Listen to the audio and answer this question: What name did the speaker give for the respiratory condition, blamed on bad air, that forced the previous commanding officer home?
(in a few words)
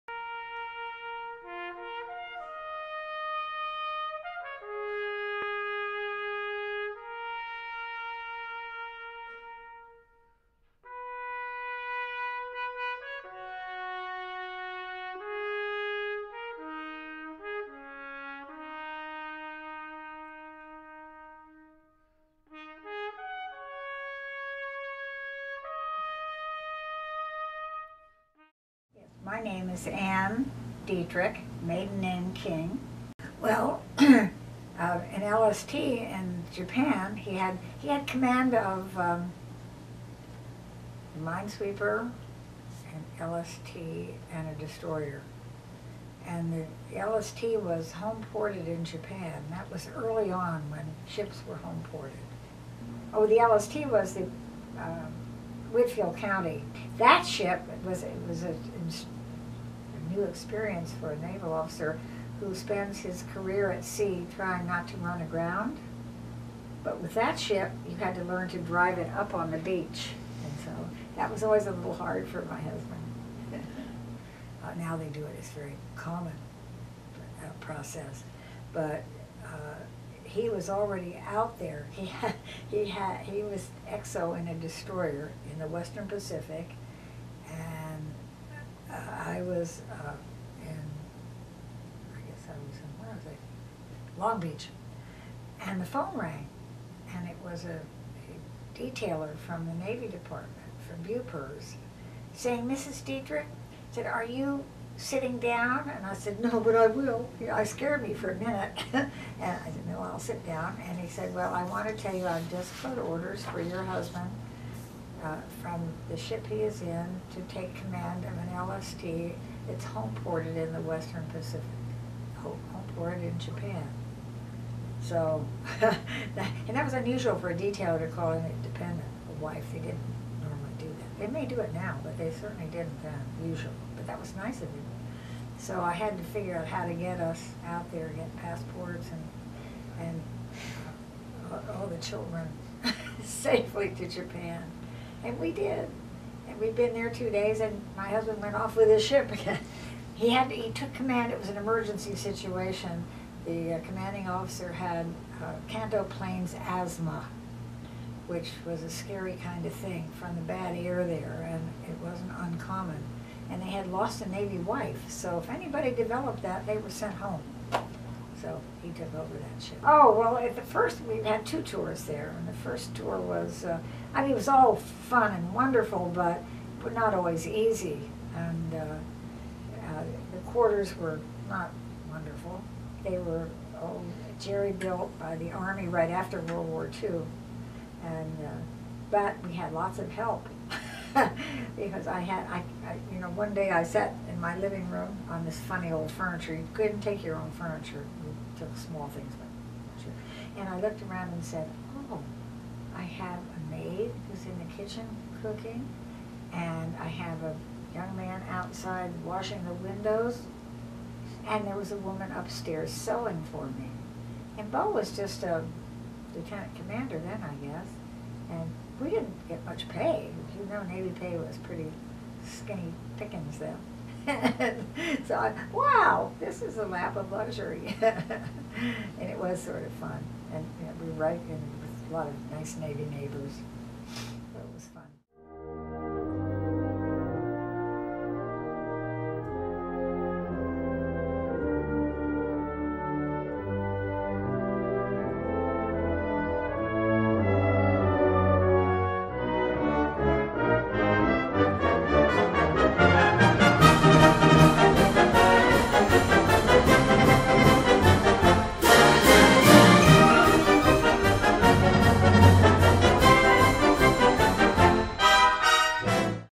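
Kanto Plains asthma.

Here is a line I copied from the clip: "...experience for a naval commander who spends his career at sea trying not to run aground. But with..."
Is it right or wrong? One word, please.
wrong.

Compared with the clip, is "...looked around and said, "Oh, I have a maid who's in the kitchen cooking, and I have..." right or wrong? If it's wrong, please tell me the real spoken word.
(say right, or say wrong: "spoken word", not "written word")
right.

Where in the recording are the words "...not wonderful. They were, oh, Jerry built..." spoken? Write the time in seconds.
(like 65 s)
181 s.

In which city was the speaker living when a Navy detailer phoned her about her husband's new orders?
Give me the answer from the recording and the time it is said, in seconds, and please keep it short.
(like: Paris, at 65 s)
Long Beach, at 94 s.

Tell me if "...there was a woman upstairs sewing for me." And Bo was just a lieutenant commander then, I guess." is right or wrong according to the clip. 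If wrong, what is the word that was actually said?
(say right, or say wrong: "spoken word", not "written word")
right.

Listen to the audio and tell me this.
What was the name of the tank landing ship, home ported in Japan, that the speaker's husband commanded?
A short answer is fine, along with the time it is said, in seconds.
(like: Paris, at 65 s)
Whitfield County, at 55 s.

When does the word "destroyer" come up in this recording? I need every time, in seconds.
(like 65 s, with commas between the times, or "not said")
44 s, 84 s.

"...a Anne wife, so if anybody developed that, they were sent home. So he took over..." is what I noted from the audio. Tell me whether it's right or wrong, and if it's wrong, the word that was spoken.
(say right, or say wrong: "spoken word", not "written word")
wrong: "Navy", not "Anne".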